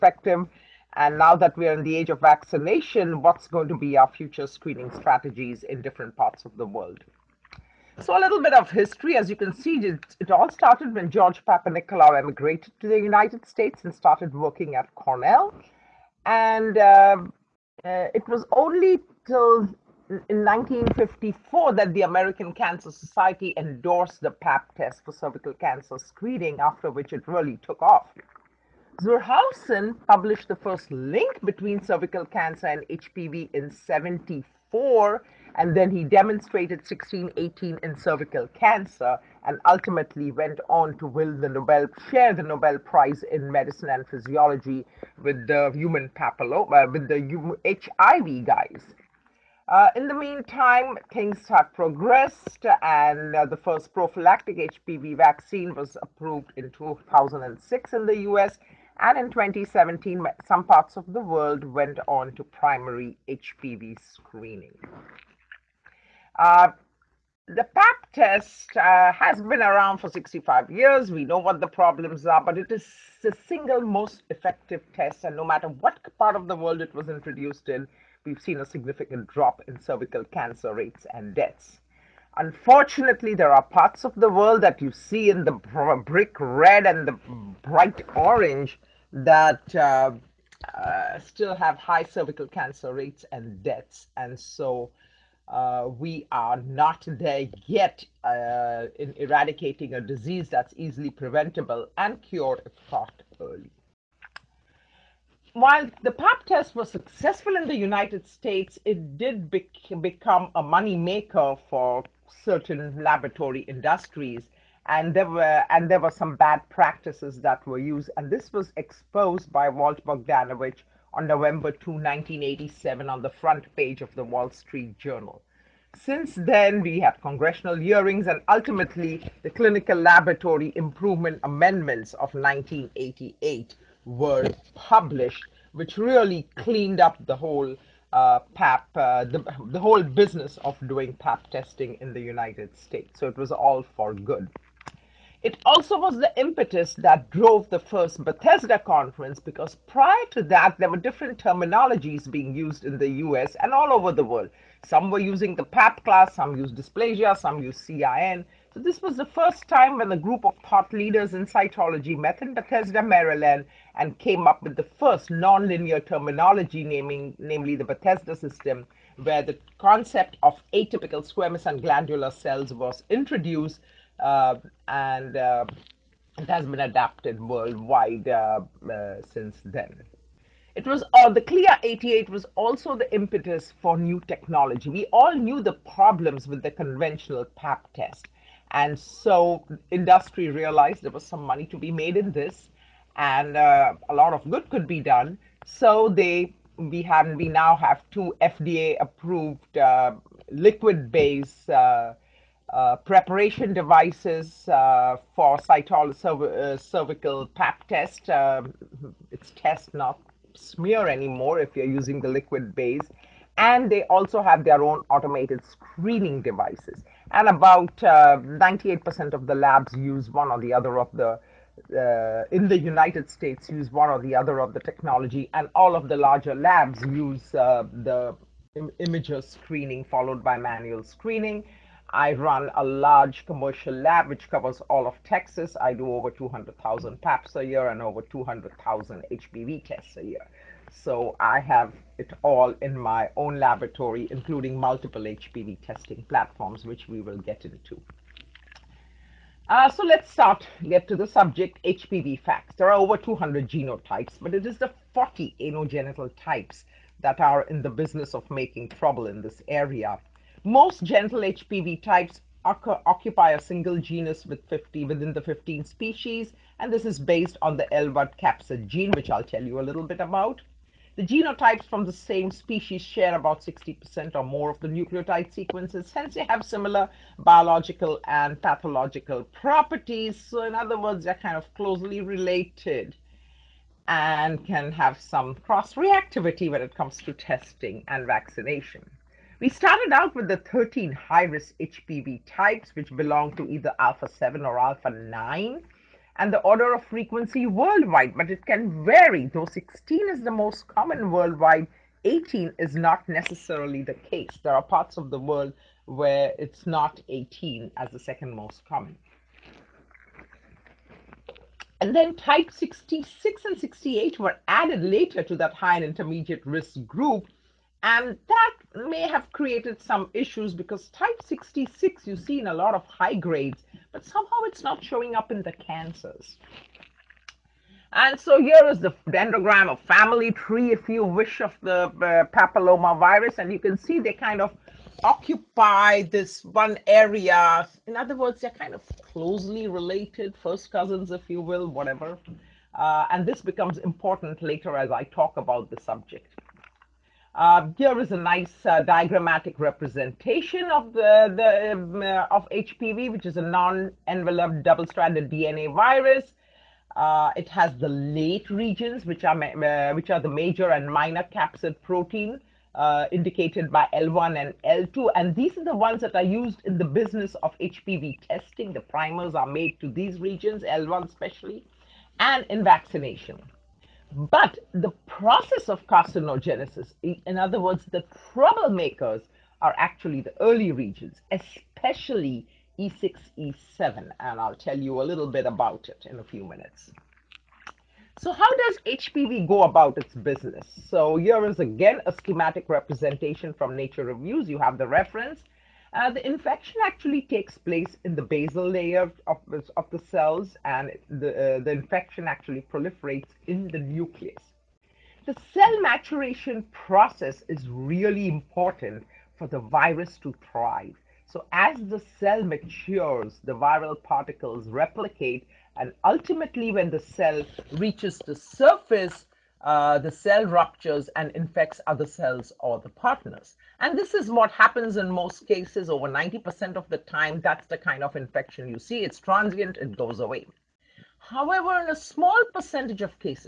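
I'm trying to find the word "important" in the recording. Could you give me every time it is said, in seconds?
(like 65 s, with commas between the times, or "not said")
343 s, 408 s.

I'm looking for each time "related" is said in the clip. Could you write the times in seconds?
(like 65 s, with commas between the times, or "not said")
282 s, 339 s.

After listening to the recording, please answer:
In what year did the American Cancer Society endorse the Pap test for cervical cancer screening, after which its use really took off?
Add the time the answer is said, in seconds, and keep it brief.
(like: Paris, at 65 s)
1954, at 20 s.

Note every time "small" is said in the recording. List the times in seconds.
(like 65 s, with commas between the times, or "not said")
432 s.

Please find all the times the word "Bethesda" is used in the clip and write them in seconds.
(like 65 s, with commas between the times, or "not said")
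148 s, 162 s, 167 s.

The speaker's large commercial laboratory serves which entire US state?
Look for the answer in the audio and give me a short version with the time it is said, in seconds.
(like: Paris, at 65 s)
Texas, at 235 s.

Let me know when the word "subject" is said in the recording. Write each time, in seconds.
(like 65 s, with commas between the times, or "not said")
251 s, 346 s.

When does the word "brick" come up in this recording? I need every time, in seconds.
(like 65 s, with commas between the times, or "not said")
86 s.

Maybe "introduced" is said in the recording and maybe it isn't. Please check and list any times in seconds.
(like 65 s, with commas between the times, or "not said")
77 s, 173 s.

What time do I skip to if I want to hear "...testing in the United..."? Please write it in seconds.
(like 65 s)
141 s.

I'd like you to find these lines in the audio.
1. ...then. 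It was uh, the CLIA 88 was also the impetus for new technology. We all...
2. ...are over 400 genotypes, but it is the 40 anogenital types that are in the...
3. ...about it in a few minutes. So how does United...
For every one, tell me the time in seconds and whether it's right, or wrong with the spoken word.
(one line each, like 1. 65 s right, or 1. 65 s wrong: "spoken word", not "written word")
1. 179 s right
2. 252 s wrong: "200", not "400"
3. 385 s wrong: "HPV", not "United".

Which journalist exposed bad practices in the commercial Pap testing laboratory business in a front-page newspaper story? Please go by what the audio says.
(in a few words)
Walt Bogdanovich.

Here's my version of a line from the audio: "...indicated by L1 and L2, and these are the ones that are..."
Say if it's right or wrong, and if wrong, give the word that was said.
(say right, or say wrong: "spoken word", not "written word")
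right.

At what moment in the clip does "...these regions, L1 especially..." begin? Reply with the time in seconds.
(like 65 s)
370 s.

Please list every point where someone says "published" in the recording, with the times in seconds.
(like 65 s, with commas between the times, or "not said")
30 s, 134 s.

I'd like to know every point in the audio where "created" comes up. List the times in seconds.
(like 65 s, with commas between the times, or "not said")
319 s.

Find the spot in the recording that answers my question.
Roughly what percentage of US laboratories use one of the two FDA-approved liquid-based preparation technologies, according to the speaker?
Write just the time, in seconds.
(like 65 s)
217 s.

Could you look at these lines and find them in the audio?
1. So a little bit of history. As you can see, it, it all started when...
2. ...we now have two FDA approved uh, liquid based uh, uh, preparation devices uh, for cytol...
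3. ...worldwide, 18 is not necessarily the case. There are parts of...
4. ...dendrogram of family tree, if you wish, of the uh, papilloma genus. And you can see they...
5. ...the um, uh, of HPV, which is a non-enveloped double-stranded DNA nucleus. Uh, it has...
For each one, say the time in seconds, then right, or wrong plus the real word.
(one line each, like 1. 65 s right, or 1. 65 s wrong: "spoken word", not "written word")
1. 8 s right
2. 197 s right
3. 301 s right
4. 329 s wrong: "virus", not "genus"
5. 351 s wrong: "virus", not "nucleus".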